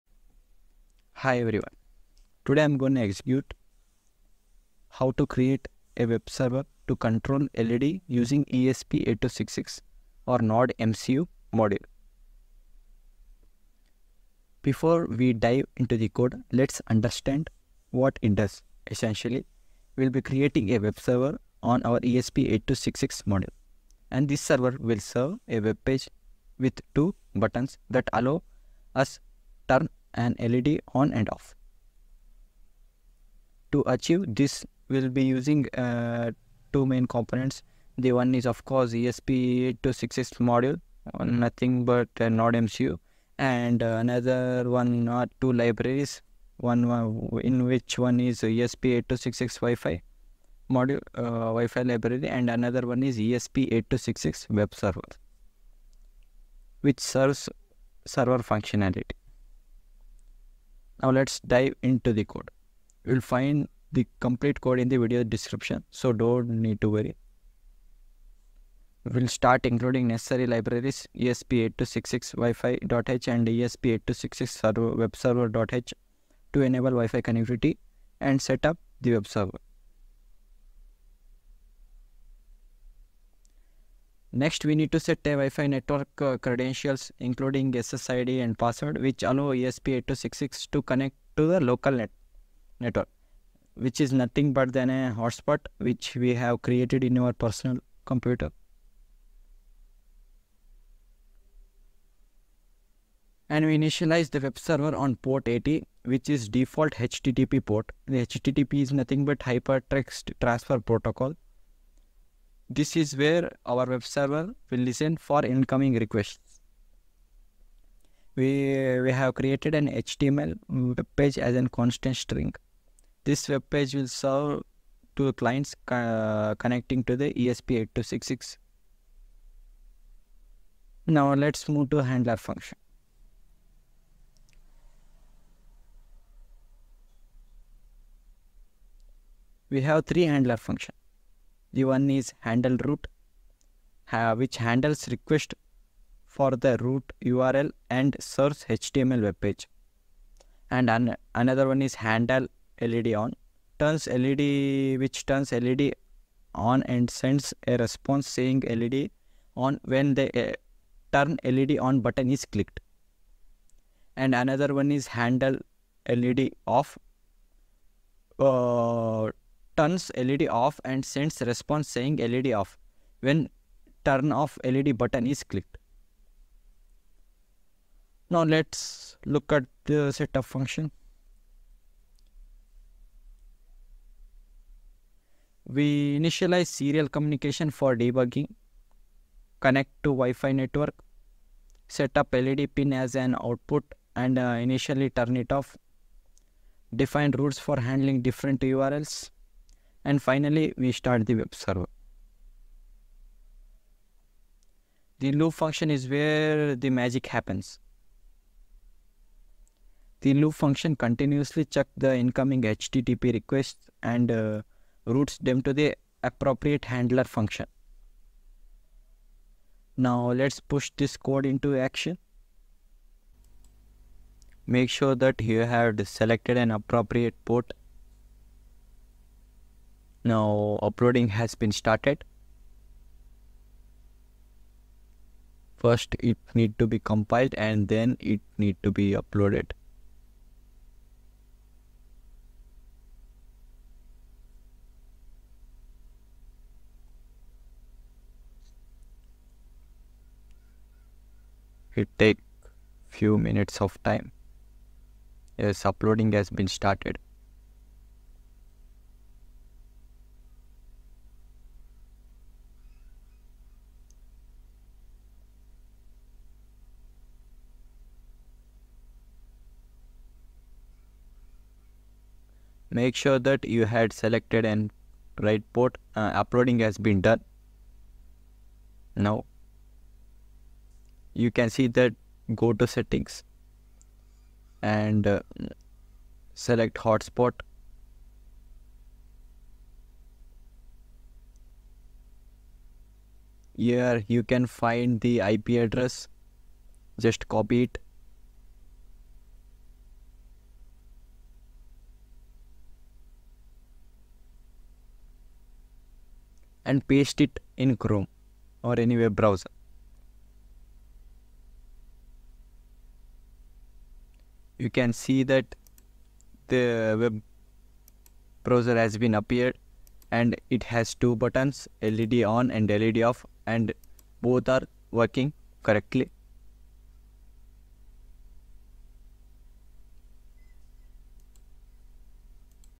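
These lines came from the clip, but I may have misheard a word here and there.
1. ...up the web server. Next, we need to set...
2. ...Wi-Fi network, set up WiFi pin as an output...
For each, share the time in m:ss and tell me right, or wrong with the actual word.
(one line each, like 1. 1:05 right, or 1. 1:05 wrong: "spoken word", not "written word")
1. 1:18 right
2. 3:10 wrong: "LED", not "WiFi".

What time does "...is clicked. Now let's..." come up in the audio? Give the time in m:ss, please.
2:55.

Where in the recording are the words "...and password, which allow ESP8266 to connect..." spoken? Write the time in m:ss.
1:28.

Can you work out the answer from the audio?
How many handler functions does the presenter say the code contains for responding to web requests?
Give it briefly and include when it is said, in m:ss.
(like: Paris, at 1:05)
3, at 2:20.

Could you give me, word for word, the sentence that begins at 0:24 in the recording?
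And this server will serve a web page with two buttons that allow us turn an LED on and off.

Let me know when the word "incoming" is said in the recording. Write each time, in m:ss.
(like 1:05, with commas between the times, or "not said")
1:55, 3:32.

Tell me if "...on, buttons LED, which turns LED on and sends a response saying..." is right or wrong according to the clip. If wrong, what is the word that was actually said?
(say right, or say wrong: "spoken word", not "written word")
wrong: "turns", not "buttons".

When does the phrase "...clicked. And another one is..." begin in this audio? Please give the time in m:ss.
2:42.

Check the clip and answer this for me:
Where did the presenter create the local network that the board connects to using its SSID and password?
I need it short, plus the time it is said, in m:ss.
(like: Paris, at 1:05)
personal computer, at 1:37.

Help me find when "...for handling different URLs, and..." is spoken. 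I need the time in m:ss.
3:17.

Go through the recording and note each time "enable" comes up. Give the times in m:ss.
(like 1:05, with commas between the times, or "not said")
1:16.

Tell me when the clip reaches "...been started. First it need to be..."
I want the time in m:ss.
3:51.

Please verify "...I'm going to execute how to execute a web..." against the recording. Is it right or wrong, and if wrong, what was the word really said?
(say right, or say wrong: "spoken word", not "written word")
wrong: "create", not "execute".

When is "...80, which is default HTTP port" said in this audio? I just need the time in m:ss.
1:45.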